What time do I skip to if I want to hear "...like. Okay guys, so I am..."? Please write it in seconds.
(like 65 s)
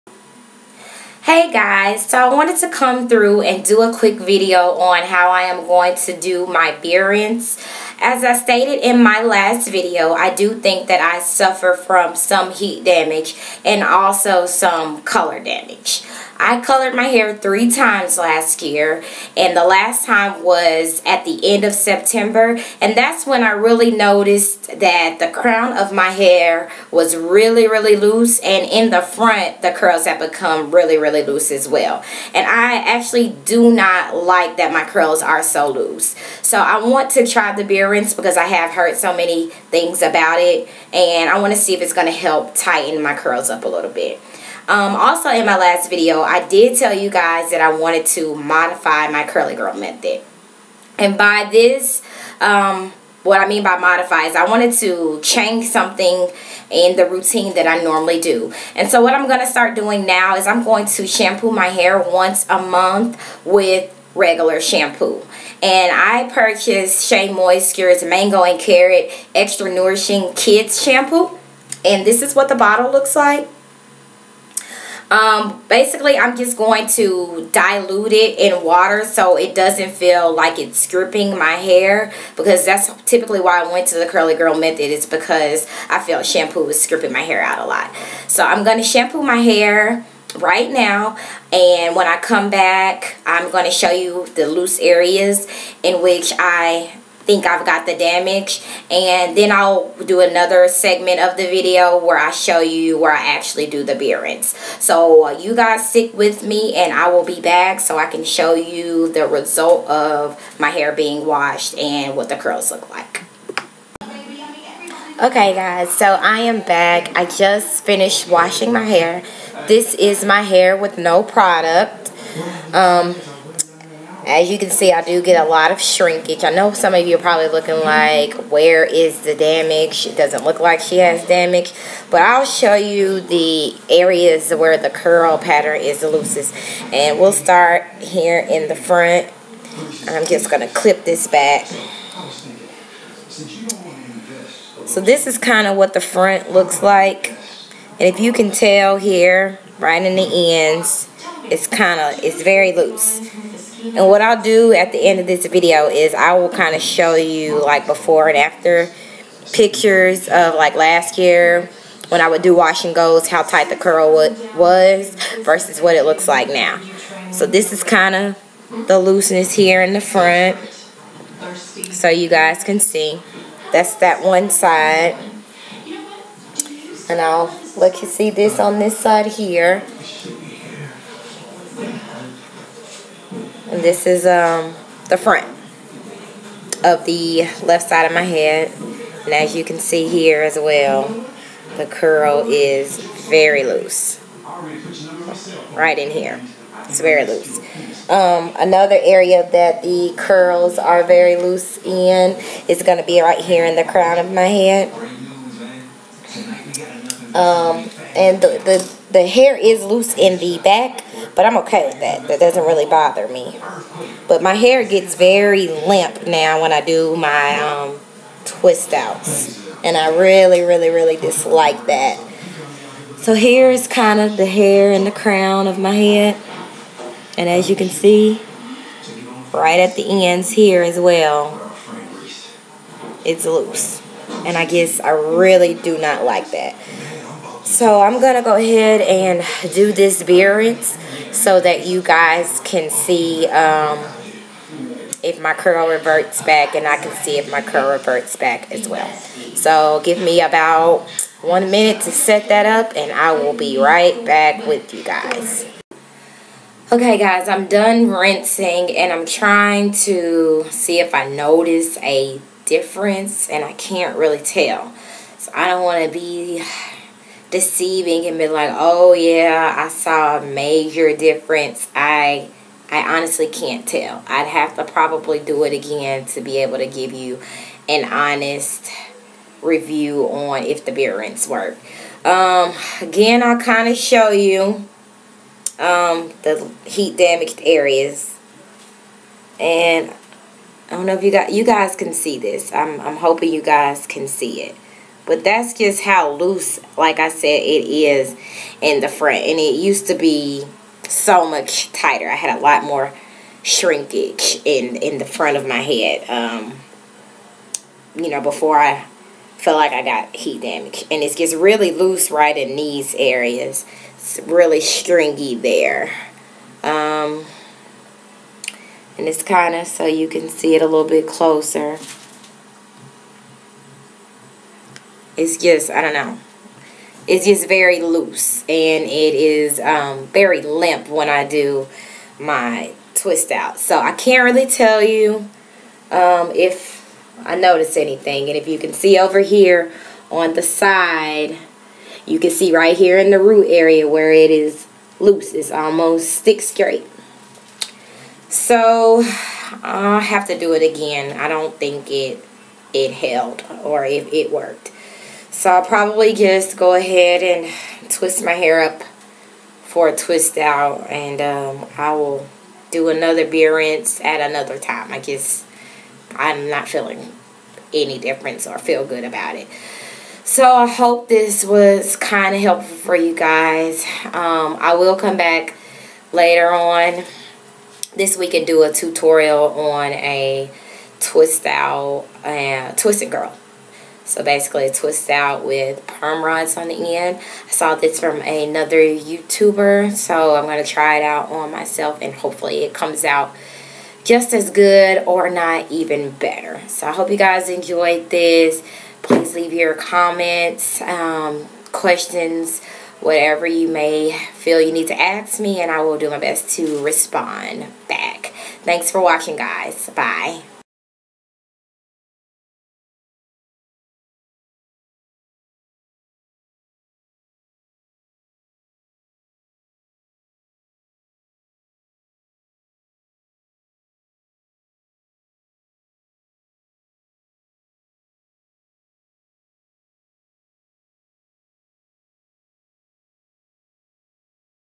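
112 s.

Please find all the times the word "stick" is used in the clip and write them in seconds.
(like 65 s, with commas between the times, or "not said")
105 s, 346 s.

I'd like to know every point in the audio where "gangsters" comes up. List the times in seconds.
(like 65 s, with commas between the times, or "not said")
not said.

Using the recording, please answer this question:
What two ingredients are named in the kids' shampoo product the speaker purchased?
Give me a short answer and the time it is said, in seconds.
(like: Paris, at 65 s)
Mango and Carrot, at 68 s.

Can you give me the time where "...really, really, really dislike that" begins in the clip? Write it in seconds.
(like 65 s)
220 s.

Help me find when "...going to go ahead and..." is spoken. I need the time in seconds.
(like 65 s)
238 s.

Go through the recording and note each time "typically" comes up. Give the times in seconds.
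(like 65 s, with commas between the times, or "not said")
83 s.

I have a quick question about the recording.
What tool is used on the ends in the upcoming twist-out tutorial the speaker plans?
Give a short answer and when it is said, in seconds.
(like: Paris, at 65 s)
Perm rods, at 386 s.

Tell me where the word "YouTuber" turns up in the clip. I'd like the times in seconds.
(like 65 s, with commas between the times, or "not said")
388 s.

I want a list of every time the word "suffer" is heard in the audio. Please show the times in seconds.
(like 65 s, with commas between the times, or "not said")
11 s.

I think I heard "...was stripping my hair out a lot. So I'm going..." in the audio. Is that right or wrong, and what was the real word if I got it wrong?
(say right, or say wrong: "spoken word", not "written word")
right.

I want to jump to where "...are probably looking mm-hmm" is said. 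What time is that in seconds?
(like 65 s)
127 s.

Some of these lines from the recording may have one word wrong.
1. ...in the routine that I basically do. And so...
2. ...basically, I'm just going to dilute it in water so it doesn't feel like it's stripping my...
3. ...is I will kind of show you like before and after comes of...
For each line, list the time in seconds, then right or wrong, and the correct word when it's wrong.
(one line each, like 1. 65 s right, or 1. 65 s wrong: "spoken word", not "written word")
1. 56 s wrong: "normally", not "basically"
2. 75 s right
3. 155 s wrong: "pictures", not "comes".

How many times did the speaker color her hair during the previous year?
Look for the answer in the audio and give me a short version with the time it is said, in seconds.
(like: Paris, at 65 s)
3, at 17 s.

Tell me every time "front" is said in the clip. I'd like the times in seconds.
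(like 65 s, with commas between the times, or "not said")
29 s, 138 s, 146 s, 170 s, 185 s, 299 s, 305 s.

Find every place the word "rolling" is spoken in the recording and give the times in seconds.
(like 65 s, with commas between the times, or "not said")
not said.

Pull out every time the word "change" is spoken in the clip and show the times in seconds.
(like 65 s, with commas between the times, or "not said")
55 s.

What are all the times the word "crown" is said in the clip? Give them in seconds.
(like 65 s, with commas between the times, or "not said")
25 s, 203 s, 225 s.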